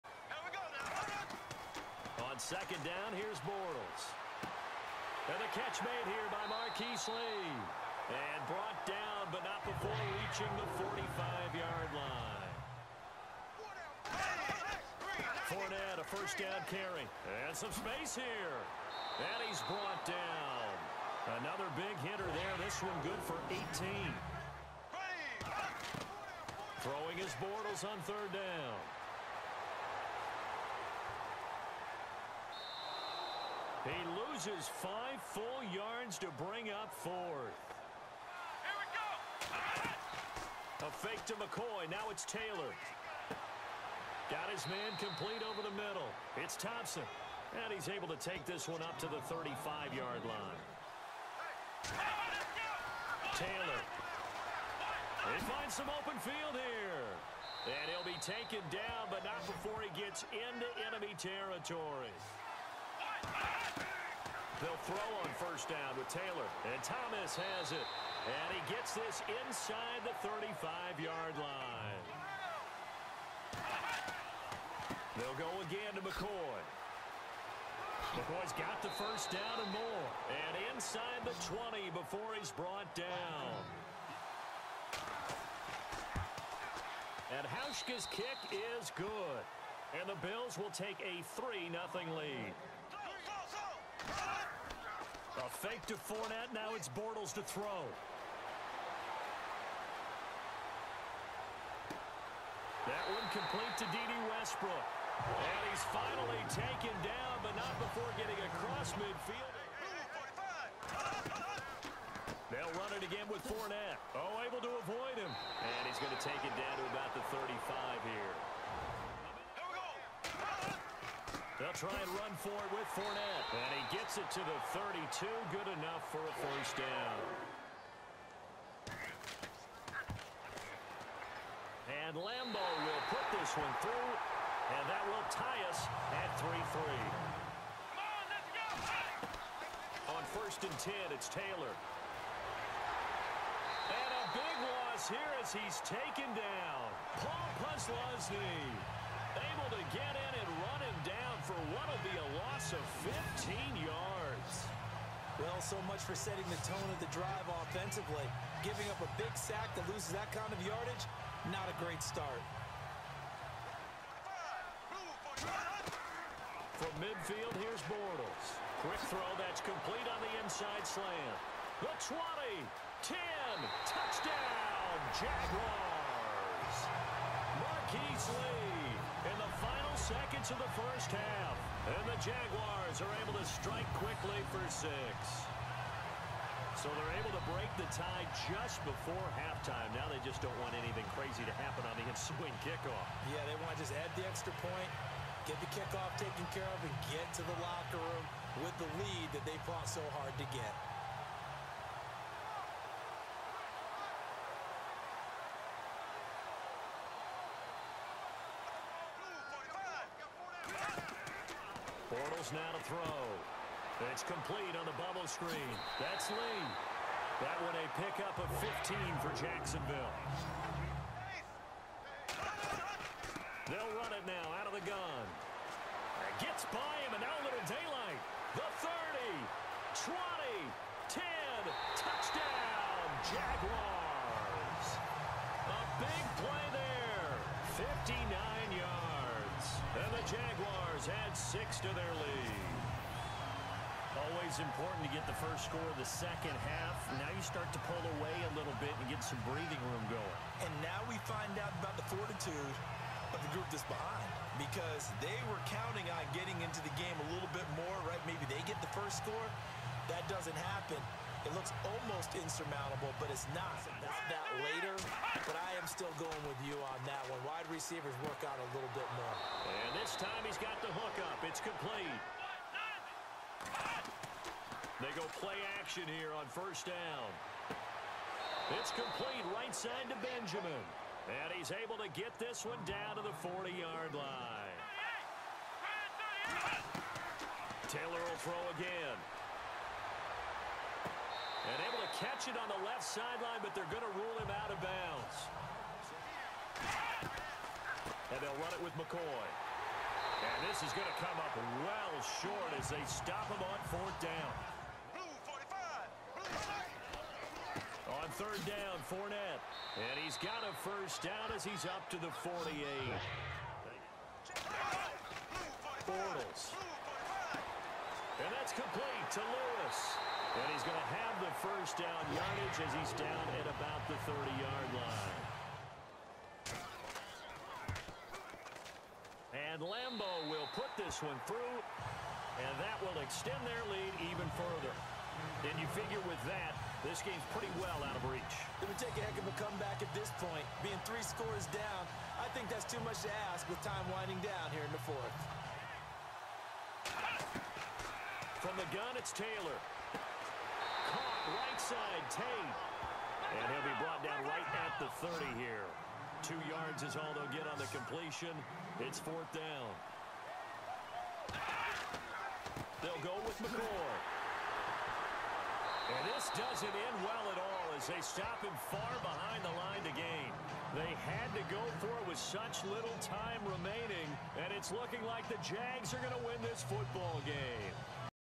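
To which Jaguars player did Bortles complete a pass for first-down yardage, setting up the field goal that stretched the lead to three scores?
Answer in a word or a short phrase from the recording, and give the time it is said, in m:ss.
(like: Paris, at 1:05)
Lewis, at 5:19.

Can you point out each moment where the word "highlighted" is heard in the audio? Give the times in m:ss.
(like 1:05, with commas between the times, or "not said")
not said.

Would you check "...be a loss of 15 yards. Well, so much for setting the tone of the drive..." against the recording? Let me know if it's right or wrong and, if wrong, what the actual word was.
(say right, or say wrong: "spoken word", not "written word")
right.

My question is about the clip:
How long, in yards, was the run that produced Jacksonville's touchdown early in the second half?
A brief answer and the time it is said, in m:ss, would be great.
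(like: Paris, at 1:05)
59, at 3:58.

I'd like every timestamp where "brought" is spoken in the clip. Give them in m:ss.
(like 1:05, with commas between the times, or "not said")
0:08, 0:19, 1:22, 5:53.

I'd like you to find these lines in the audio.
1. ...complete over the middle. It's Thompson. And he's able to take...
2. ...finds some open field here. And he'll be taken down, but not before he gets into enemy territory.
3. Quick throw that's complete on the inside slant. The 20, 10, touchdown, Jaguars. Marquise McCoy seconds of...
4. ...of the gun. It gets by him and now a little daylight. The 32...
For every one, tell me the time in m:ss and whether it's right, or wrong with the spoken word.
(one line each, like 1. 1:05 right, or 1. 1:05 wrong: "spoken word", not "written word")
1. 0:45 right
2. 0:55 right
3. 2:48 wrong: "Lee", not "McCoy"
4. 3:44 wrong: "30", not "32".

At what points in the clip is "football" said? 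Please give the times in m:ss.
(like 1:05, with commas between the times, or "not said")
6:16.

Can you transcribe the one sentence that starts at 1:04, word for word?
They'll throw on first down with Taylor.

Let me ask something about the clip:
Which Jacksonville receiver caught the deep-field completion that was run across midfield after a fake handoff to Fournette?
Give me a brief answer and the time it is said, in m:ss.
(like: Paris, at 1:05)
Dede Westbrook, at 1:43.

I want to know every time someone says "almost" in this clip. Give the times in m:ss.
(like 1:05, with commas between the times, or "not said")
4:21.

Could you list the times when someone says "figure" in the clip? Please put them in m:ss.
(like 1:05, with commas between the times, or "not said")
5:35.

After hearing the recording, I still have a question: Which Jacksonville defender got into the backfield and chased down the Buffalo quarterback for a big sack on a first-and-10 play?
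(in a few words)
Paul Posluszny.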